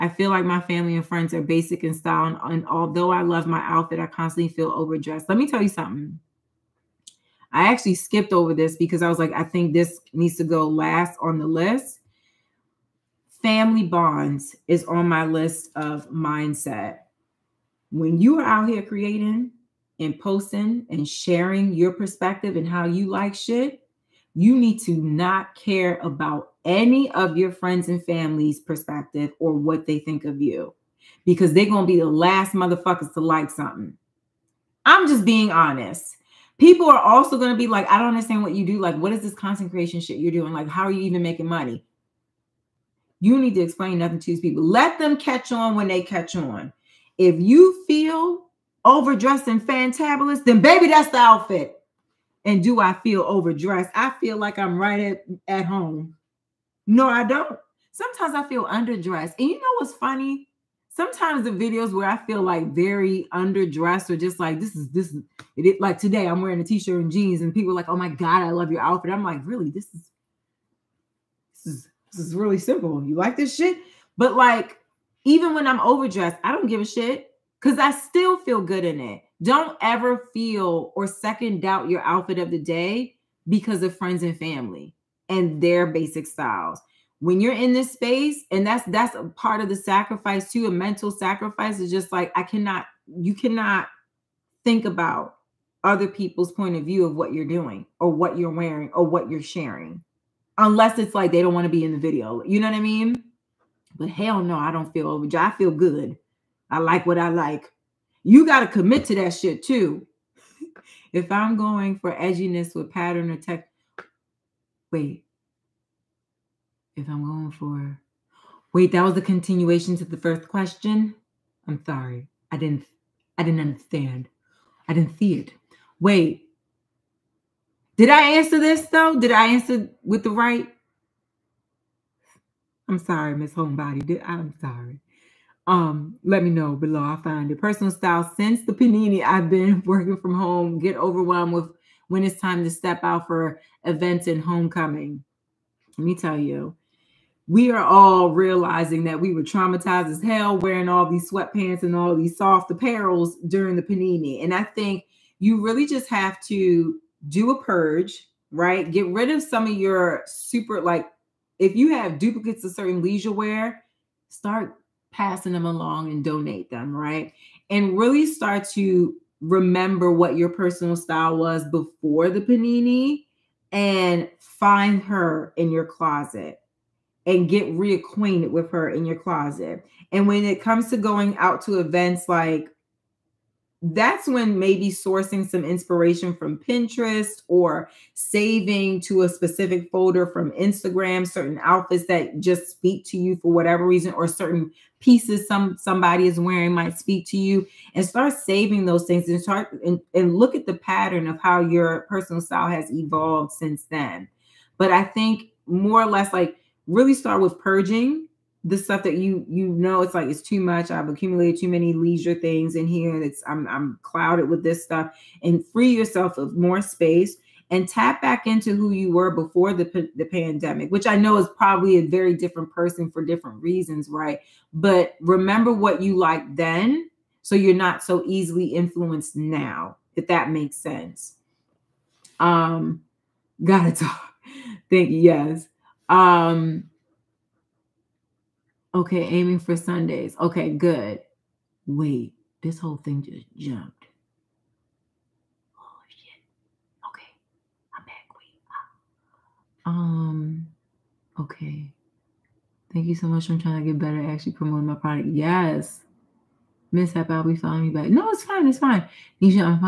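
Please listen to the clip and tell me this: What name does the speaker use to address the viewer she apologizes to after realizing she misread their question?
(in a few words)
Miss Homebody.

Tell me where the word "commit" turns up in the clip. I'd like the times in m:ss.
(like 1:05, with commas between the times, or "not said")
1:48.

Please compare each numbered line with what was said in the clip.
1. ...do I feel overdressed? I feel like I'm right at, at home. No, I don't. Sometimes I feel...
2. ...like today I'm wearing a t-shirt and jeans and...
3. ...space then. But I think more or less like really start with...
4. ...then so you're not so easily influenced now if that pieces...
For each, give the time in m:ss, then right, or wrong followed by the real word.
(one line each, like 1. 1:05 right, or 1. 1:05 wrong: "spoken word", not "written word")
1. 0:52 right
2. 1:05 right
3. 3:23 wrong: "since", not "space"
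4. 3:46 wrong: "makes", not "pieces".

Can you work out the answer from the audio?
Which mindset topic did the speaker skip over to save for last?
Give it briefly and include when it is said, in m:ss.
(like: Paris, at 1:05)
Family bonds, at 0:13.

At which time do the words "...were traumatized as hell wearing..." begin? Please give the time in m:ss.
2:29.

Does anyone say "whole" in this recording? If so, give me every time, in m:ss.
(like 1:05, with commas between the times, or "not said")
4:02.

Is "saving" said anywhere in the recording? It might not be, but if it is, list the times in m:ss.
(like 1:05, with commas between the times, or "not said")
3:08, 3:18.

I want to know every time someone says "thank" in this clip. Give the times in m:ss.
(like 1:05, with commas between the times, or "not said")
3:54, 4:12.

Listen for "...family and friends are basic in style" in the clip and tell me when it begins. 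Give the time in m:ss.
0:00.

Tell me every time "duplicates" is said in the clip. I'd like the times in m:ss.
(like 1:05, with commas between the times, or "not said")
2:42.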